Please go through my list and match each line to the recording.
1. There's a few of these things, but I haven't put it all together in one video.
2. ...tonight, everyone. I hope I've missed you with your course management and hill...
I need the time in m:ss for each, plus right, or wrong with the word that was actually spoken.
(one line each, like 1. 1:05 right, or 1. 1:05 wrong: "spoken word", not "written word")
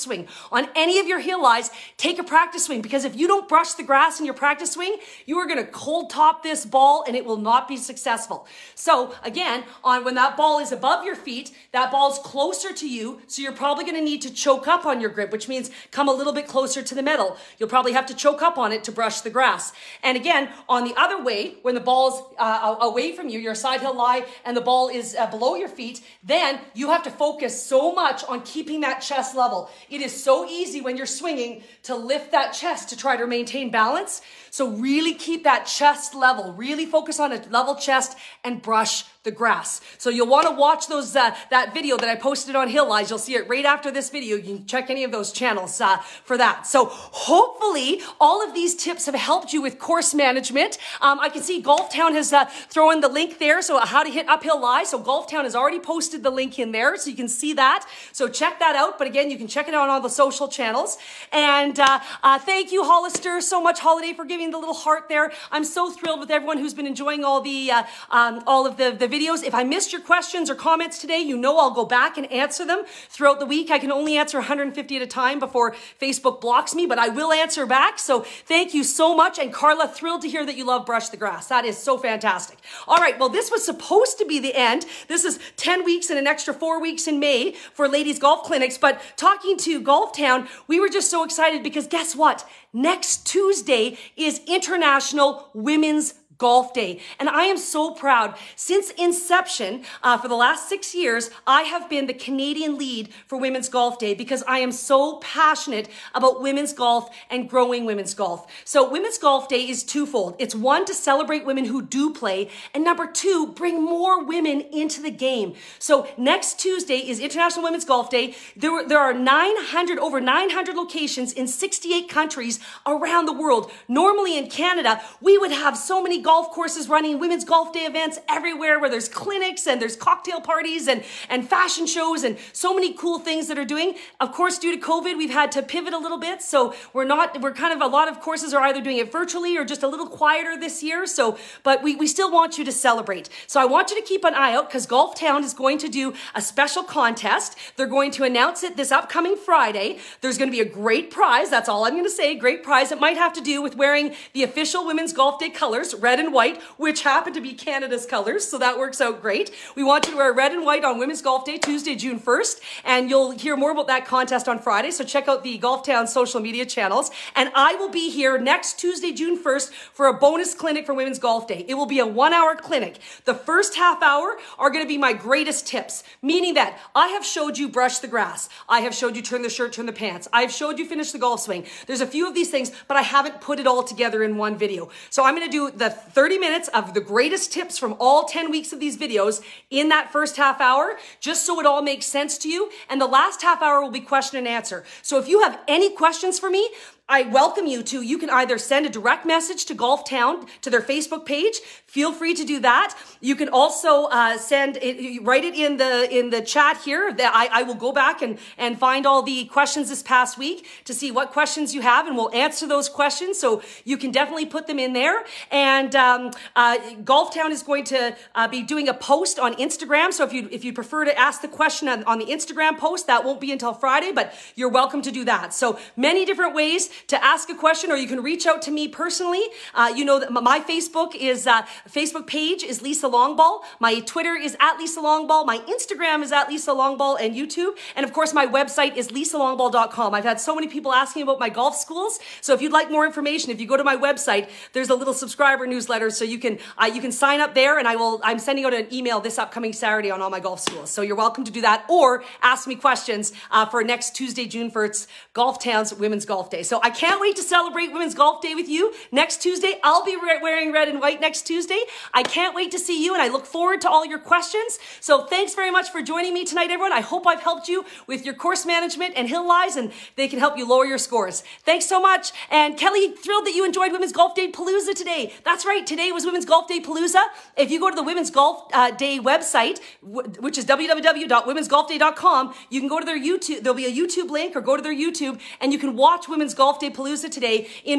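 1. 3:01 right
2. 4:26 wrong: "helped", not "missed".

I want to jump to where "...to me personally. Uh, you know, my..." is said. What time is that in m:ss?
3:48.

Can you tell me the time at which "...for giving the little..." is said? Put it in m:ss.
1:04.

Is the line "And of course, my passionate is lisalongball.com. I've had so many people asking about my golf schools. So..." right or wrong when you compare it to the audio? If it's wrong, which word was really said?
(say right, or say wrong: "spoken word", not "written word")
wrong: "website", not "passionate".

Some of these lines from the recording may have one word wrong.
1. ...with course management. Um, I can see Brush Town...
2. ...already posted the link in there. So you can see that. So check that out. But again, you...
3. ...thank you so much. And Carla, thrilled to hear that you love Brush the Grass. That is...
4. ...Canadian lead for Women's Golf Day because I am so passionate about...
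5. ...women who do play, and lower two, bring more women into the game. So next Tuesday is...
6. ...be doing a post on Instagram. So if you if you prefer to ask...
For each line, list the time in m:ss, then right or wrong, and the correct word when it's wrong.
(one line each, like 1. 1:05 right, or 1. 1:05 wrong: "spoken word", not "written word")
1. 0:49 wrong: "Golf", not "Brush"
2. 0:55 right
3. 1:18 right
4. 1:42 right
5. 1:51 wrong: "number", not "lower"
6. 3:38 right.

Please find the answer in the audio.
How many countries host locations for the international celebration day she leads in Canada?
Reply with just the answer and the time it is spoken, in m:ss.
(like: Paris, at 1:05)
68, at 2:01.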